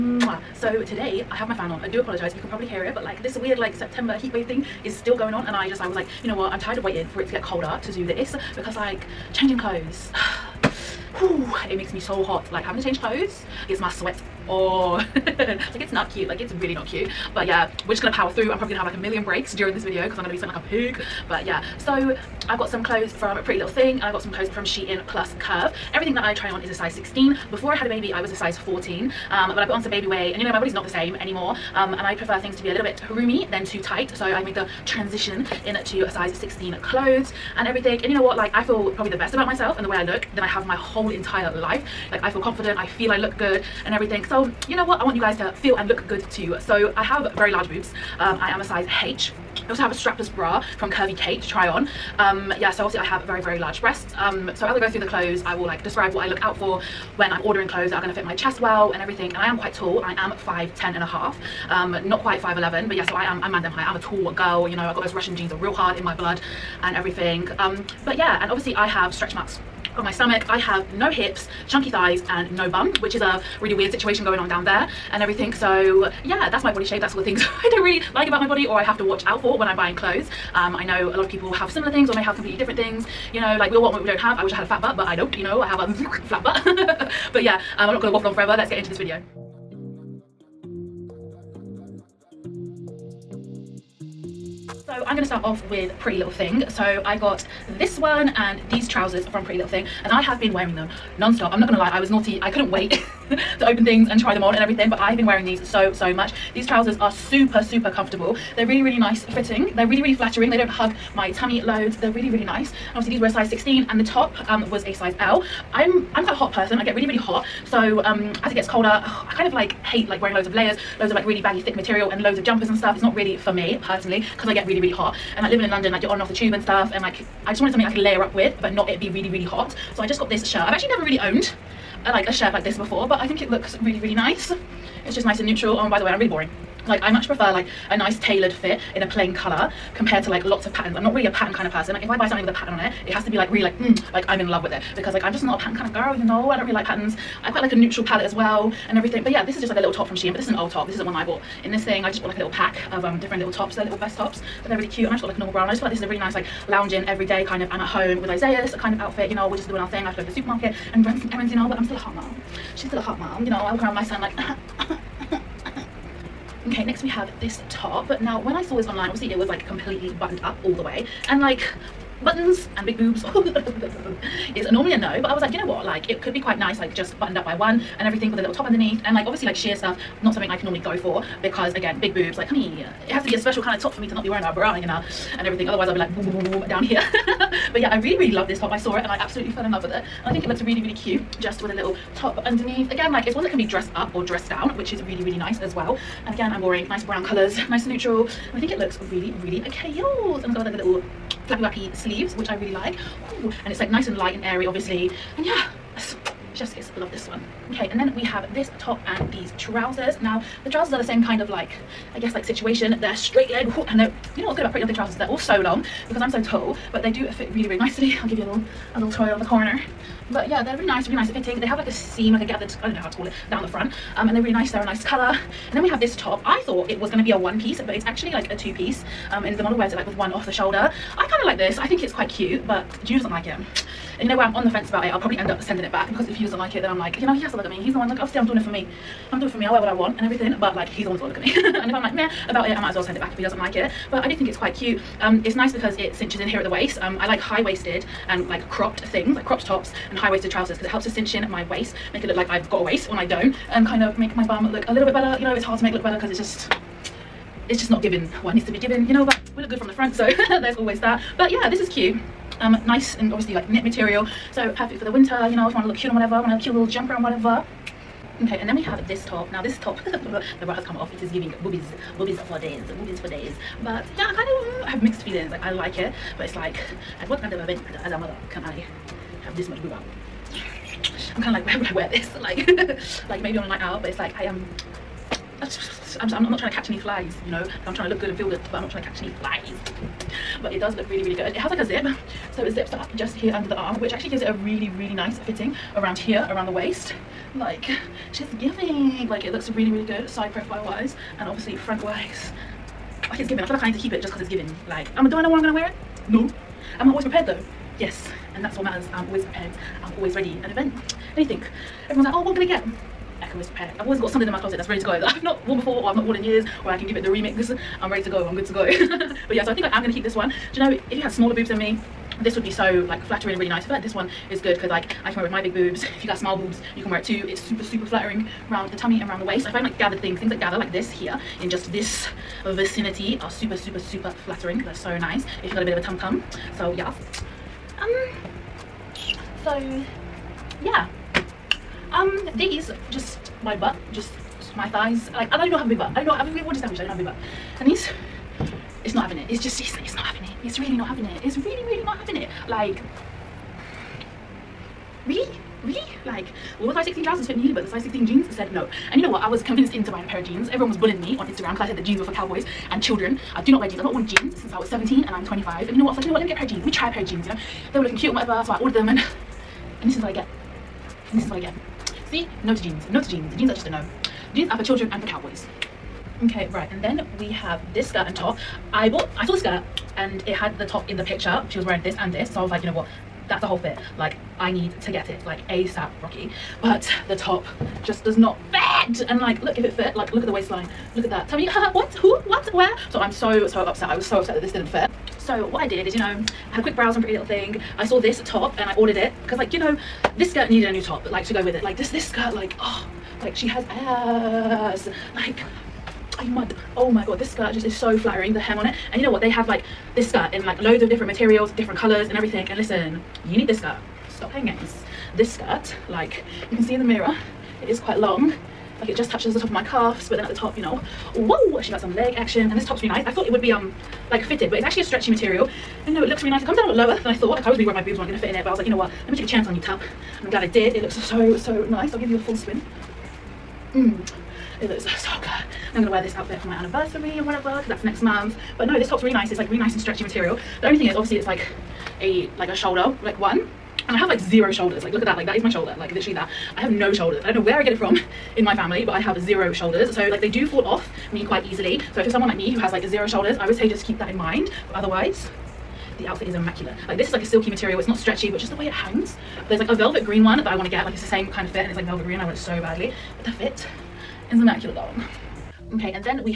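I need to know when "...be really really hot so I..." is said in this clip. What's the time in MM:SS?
02:08.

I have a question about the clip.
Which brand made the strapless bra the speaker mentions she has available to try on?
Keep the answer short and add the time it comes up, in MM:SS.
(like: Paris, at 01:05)
Curvy Kate, at 00:50.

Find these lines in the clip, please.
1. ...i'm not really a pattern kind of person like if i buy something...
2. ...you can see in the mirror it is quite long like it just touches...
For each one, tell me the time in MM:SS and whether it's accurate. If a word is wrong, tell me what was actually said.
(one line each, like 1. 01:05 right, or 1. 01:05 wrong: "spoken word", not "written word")
1. 02:20 right
2. 06:56 right.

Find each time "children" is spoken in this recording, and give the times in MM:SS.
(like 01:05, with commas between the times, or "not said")
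06:03, 06:14.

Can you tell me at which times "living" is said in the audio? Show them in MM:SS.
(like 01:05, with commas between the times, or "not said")
02:05.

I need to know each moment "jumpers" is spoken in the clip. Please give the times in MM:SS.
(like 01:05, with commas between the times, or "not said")
02:02, 04:26.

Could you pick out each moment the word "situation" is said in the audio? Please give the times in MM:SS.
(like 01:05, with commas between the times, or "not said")
01:13, 03:32.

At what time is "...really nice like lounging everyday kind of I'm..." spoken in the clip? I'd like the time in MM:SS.
02:36.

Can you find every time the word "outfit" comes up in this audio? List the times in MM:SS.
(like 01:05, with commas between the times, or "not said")
02:38, 07:16, 07:36.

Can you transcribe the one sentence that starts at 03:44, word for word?
Um, and they're really nice, they're a nice color.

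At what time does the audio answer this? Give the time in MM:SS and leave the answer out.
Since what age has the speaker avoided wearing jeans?
06:04.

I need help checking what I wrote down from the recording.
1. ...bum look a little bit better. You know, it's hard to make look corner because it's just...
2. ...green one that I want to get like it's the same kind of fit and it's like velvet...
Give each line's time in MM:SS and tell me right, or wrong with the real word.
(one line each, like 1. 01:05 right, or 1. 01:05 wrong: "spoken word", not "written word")
1. 04:14 wrong: "better", not "corner"
2. 07:40 right.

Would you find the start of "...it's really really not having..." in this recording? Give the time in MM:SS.
05:51.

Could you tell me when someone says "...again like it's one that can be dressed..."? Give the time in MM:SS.
03:12.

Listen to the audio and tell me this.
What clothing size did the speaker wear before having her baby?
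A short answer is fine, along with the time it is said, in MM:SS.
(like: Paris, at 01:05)
14, at 00:28.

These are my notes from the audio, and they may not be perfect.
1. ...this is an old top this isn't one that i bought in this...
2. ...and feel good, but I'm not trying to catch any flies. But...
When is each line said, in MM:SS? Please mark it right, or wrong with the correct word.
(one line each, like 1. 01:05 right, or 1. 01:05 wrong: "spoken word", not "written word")
1. 02:30 right
2. 04:48 right.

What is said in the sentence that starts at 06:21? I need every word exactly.
She was wearing this and this, so I was like, you know what, that's the whole fit.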